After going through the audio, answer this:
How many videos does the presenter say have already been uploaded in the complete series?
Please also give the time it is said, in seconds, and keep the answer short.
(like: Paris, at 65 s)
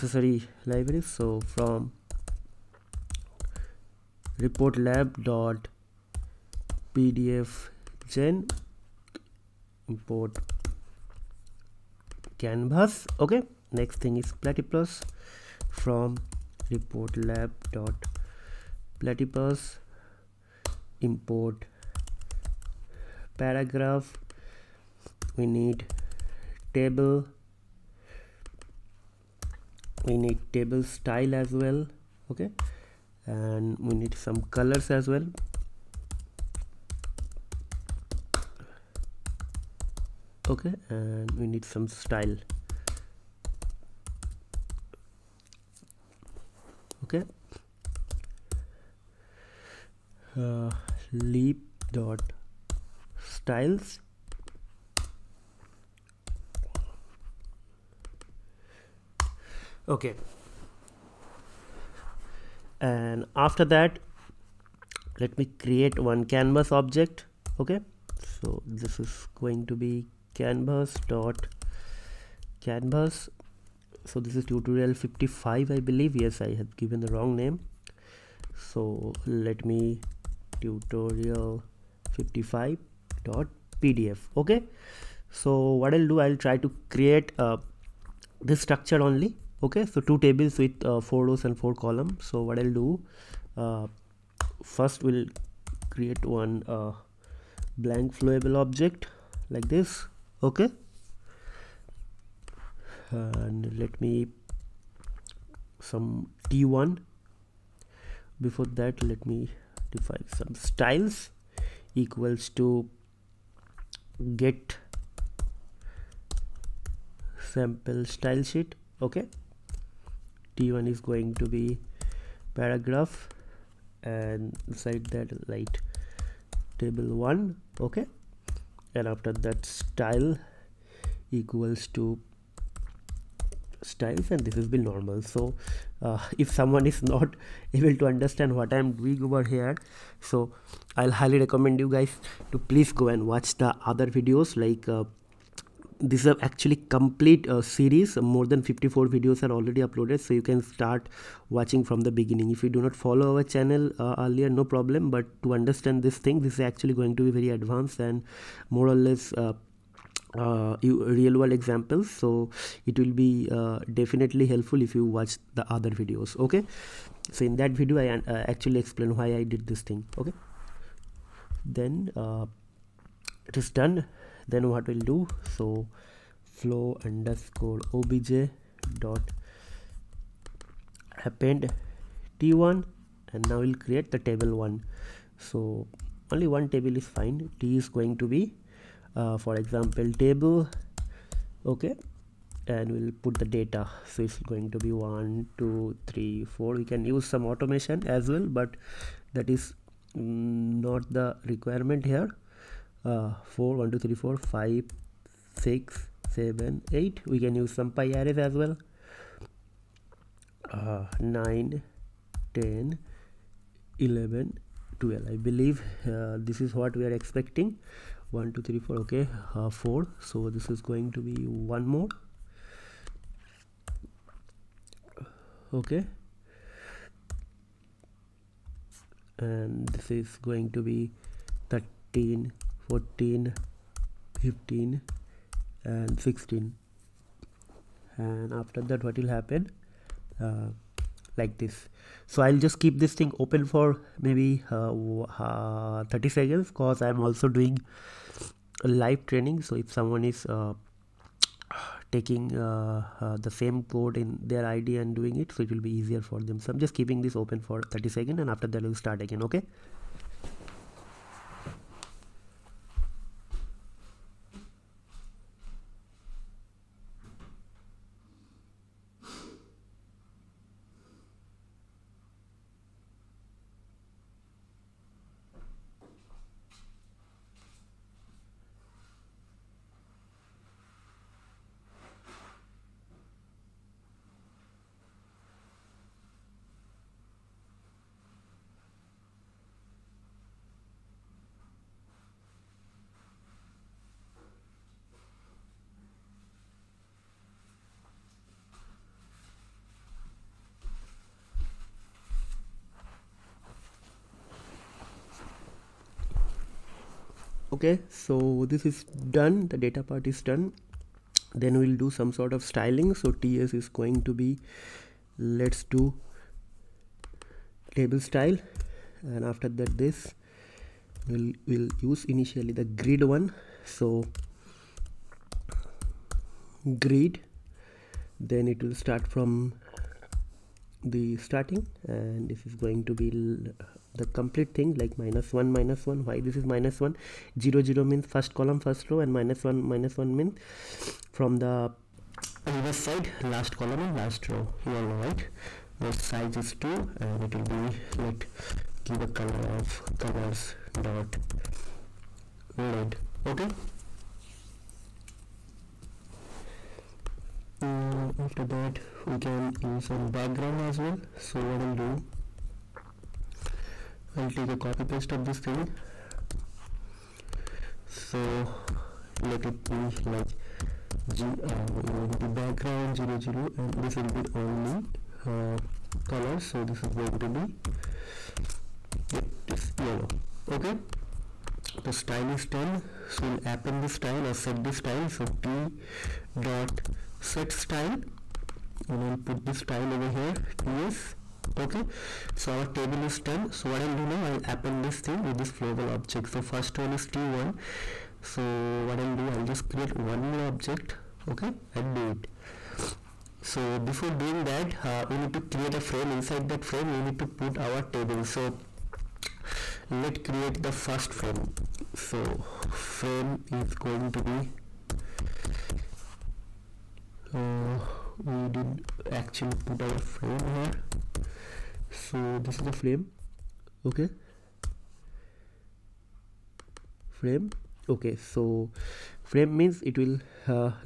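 more than 54, at 148 s.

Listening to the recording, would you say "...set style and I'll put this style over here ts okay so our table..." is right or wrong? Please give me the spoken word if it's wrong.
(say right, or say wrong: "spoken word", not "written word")
right.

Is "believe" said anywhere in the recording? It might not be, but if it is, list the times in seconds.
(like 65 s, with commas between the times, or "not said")
75 s, 215 s.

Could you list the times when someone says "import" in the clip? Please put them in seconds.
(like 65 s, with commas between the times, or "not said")
9 s, 21 s.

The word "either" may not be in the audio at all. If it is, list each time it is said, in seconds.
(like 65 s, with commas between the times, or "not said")
not said.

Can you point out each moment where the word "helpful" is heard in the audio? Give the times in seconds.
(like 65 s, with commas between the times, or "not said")
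164 s.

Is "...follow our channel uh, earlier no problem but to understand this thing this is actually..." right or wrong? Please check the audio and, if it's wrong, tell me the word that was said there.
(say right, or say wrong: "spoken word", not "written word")
right.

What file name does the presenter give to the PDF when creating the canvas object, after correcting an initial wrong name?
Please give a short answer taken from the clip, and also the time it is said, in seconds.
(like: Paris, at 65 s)
tutorial 55.pdf, at 80 s.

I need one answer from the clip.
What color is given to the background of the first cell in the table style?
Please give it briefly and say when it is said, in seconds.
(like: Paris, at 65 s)
yellow, at 379 s.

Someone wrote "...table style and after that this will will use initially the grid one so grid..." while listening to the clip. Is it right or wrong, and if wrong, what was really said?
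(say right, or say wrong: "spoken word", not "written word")
right.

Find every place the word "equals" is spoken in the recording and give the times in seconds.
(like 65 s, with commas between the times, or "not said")
111 s, 131 s.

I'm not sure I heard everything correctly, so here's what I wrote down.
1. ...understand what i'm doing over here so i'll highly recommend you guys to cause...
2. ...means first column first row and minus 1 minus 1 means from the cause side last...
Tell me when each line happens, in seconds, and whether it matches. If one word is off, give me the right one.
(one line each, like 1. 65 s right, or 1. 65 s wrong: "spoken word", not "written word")
1. 138 s wrong: "please", not "cause"
2. 338 s wrong: "reverse", not "cause".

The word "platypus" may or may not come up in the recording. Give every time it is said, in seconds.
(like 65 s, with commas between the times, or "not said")
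14 s, 19 s.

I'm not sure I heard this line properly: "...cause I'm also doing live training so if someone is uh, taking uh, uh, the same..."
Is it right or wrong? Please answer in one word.
right.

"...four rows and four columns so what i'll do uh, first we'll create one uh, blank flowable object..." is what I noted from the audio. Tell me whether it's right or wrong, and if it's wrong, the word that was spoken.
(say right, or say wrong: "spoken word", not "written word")
right.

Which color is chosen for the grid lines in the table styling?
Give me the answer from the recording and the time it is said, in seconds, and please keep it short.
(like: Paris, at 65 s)
red, at 350 s.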